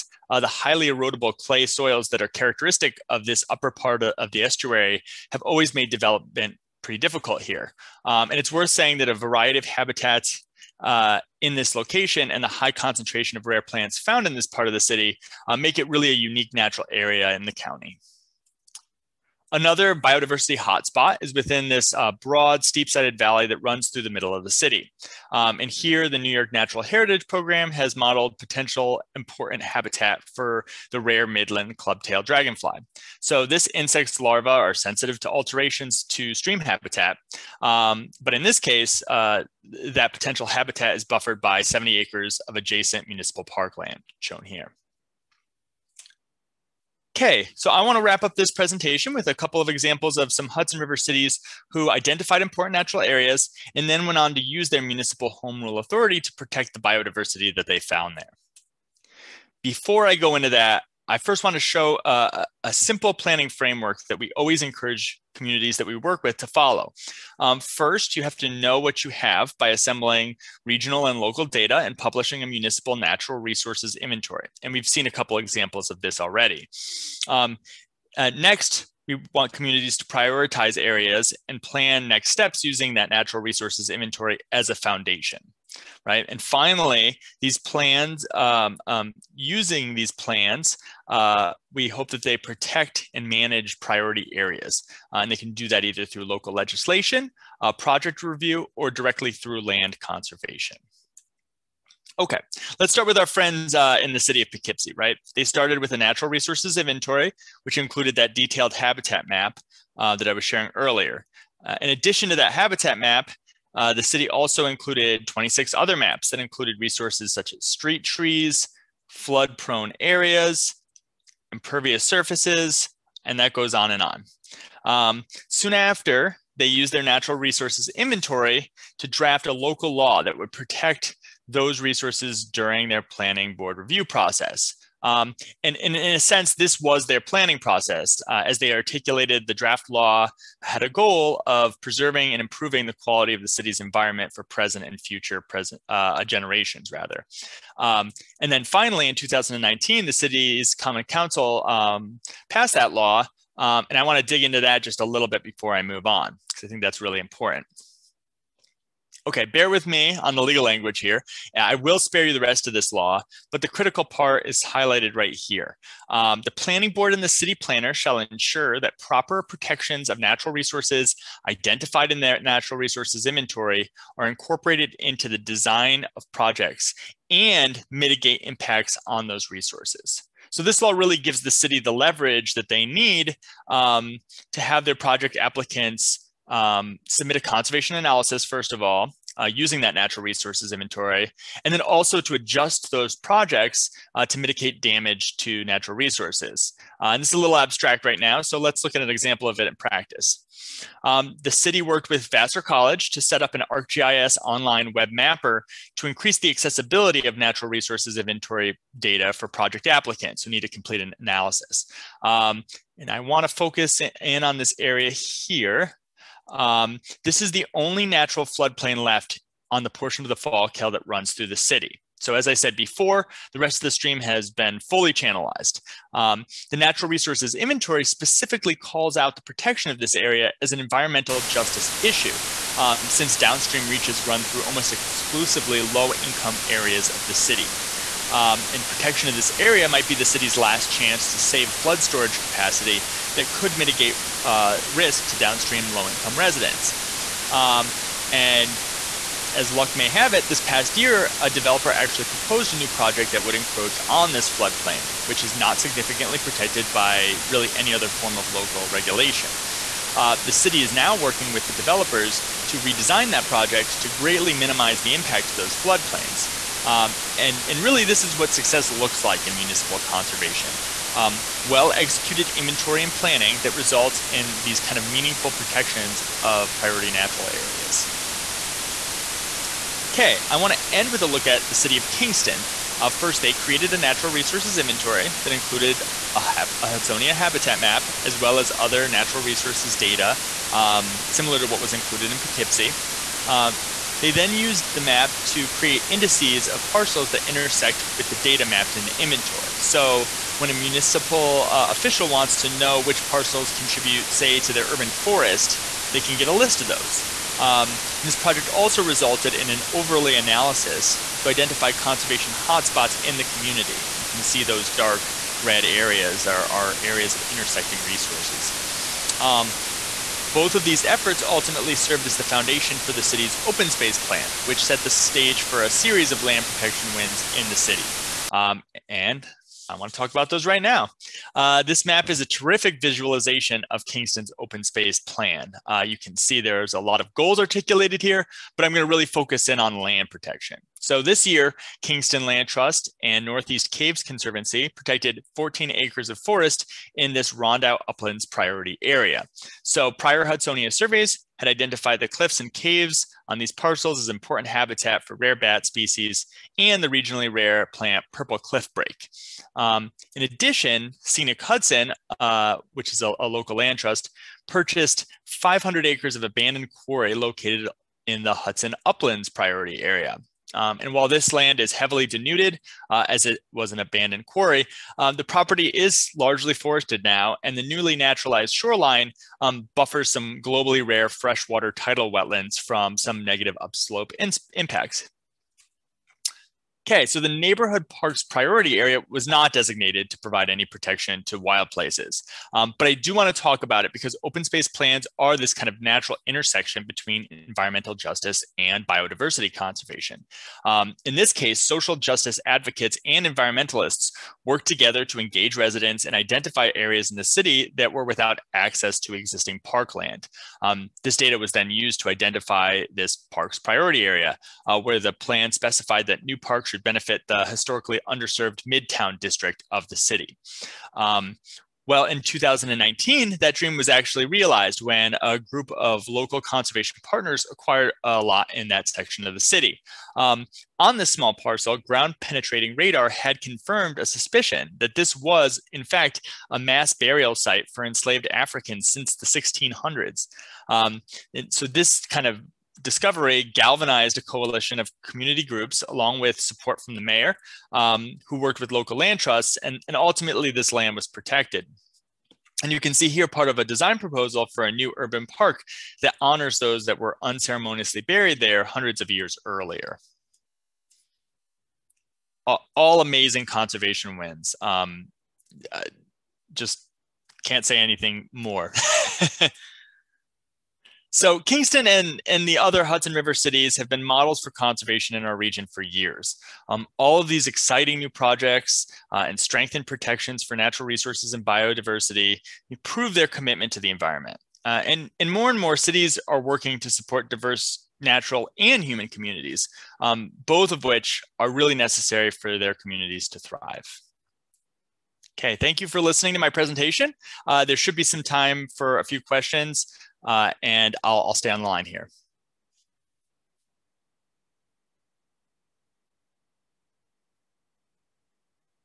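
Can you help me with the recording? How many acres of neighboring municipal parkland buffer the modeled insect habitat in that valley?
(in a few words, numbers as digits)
70.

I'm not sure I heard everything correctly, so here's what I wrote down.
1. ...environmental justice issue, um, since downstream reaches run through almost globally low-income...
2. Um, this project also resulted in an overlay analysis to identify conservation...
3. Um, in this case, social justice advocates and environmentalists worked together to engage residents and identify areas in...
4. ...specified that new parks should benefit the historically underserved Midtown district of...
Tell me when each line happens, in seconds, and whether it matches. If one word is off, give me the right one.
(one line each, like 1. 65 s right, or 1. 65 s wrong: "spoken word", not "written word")
1. 230 s wrong: "exclusively", not "globally"
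2. 307 s right
3. 400 s right
4. 415 s right.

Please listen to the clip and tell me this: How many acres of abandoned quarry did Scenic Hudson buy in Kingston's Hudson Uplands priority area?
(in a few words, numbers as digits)
500.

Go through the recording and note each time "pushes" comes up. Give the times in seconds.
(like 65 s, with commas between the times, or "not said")
not said.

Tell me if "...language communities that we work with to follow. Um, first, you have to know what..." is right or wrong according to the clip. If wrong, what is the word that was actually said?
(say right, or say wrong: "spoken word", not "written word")
wrong: "encourage", not "language".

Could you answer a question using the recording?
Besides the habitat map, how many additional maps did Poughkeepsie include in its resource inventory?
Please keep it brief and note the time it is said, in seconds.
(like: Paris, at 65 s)
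26, at 115 s.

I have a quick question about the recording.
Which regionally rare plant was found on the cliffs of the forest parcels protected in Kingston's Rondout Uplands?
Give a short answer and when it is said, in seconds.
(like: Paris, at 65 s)
purple cliff brake, at 358 s.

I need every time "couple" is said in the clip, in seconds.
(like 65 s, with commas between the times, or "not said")
49 s, 75 s.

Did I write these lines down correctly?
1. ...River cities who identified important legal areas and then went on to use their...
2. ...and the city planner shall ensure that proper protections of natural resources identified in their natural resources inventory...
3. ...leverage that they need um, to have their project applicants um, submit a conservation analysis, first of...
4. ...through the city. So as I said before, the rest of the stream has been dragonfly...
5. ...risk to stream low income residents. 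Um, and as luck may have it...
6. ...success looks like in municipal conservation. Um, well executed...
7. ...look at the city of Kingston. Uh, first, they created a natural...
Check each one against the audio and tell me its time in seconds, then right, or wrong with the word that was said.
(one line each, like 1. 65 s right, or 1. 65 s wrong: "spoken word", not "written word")
1. 50 s wrong: "natural", not "legal"
2. 167 s right
3. 181 s right
4. 221 s wrong: "fully", not "dragonfly"
5. 244 s wrong: "downstream", not "stream"
6. 268 s right
7. 281 s right.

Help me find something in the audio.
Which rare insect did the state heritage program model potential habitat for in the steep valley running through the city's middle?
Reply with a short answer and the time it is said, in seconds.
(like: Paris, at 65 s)
Midland clubtail dragonfly, at 31 s.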